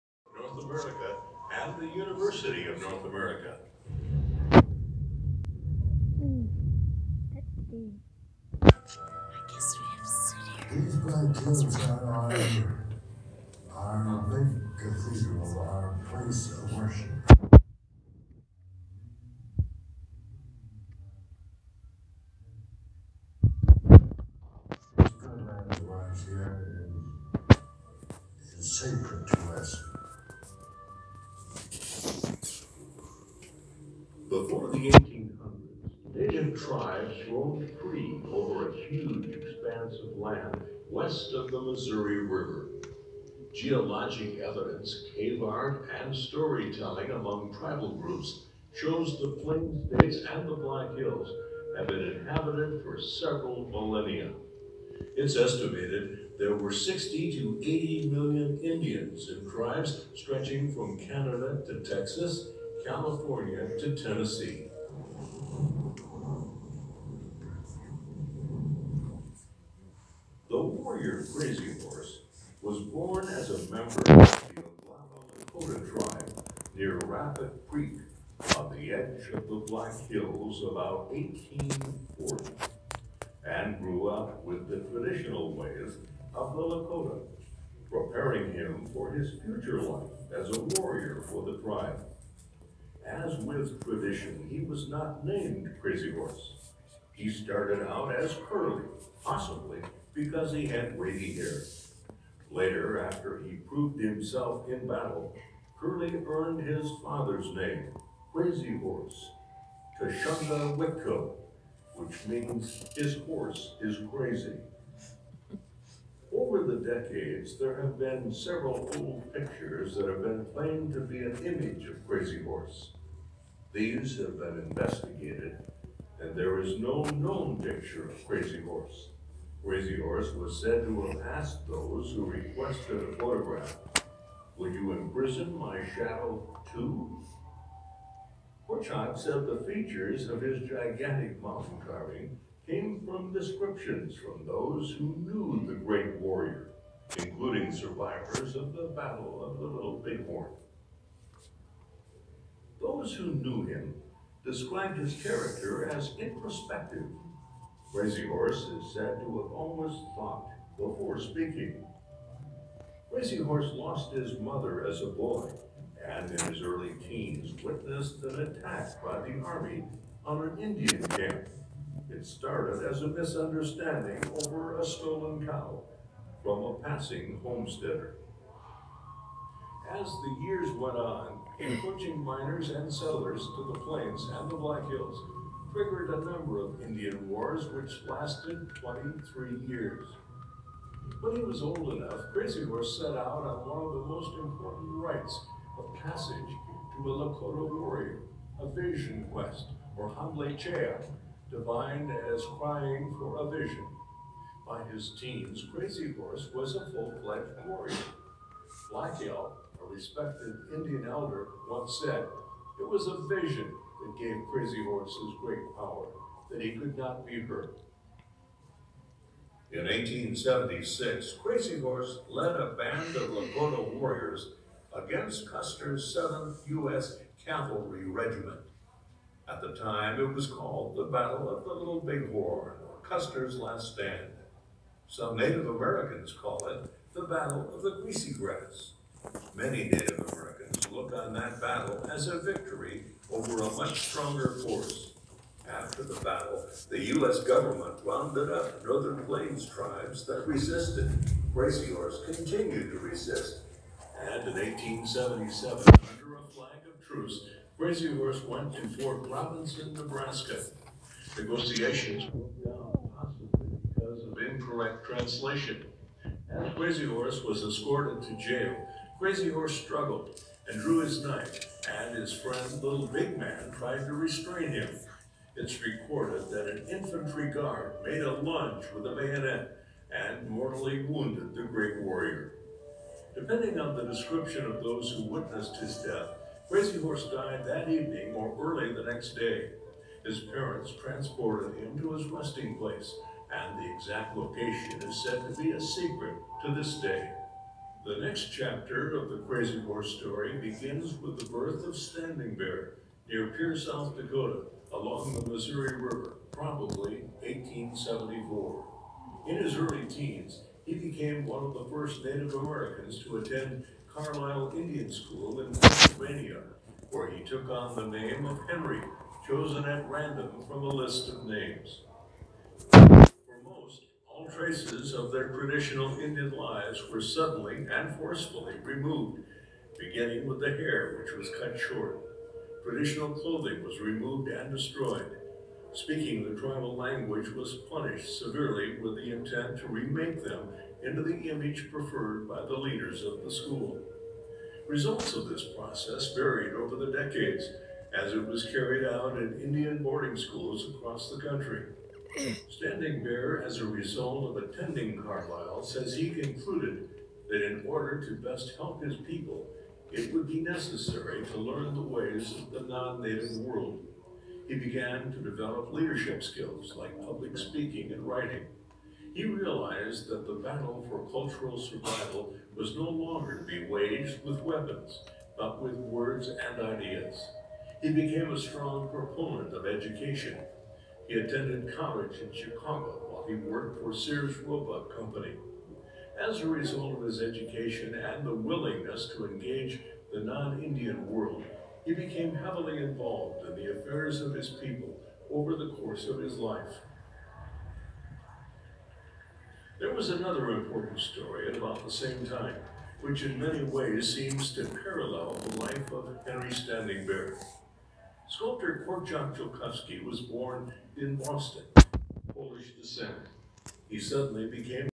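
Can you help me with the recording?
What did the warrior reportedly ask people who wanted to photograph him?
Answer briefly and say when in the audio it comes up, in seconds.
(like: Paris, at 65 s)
Would you imprison my shadow too?, at 134 s.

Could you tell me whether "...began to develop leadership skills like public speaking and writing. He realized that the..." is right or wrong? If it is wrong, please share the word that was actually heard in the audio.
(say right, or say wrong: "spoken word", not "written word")
right.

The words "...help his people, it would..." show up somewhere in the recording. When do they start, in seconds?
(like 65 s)
358 s.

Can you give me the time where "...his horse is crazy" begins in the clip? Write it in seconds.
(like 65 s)
112 s.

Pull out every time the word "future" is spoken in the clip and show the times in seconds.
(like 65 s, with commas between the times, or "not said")
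89 s.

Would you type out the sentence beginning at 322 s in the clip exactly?
For most, all traces of their traditional Indian lives were suddenly and forcefully removed, beginning with the hair, which was cut short.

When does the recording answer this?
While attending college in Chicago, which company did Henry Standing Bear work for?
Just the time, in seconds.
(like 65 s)
384 s.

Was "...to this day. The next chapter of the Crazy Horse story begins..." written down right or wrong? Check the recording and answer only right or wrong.
right.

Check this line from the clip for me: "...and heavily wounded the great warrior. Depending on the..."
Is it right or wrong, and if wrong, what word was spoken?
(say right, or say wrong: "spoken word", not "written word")
wrong: "mortally", not "heavily".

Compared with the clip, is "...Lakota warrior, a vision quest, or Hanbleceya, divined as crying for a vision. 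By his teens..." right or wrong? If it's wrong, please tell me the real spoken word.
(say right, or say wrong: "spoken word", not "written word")
right.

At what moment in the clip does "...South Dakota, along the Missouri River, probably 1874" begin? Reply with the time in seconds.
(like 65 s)
303 s.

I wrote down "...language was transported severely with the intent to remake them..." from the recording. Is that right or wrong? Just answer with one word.
wrong.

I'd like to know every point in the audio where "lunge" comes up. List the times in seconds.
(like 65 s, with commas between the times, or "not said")
278 s.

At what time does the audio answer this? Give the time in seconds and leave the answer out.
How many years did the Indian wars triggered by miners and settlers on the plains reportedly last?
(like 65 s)
188 s.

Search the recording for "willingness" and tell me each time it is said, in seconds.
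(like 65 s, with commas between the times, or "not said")
388 s.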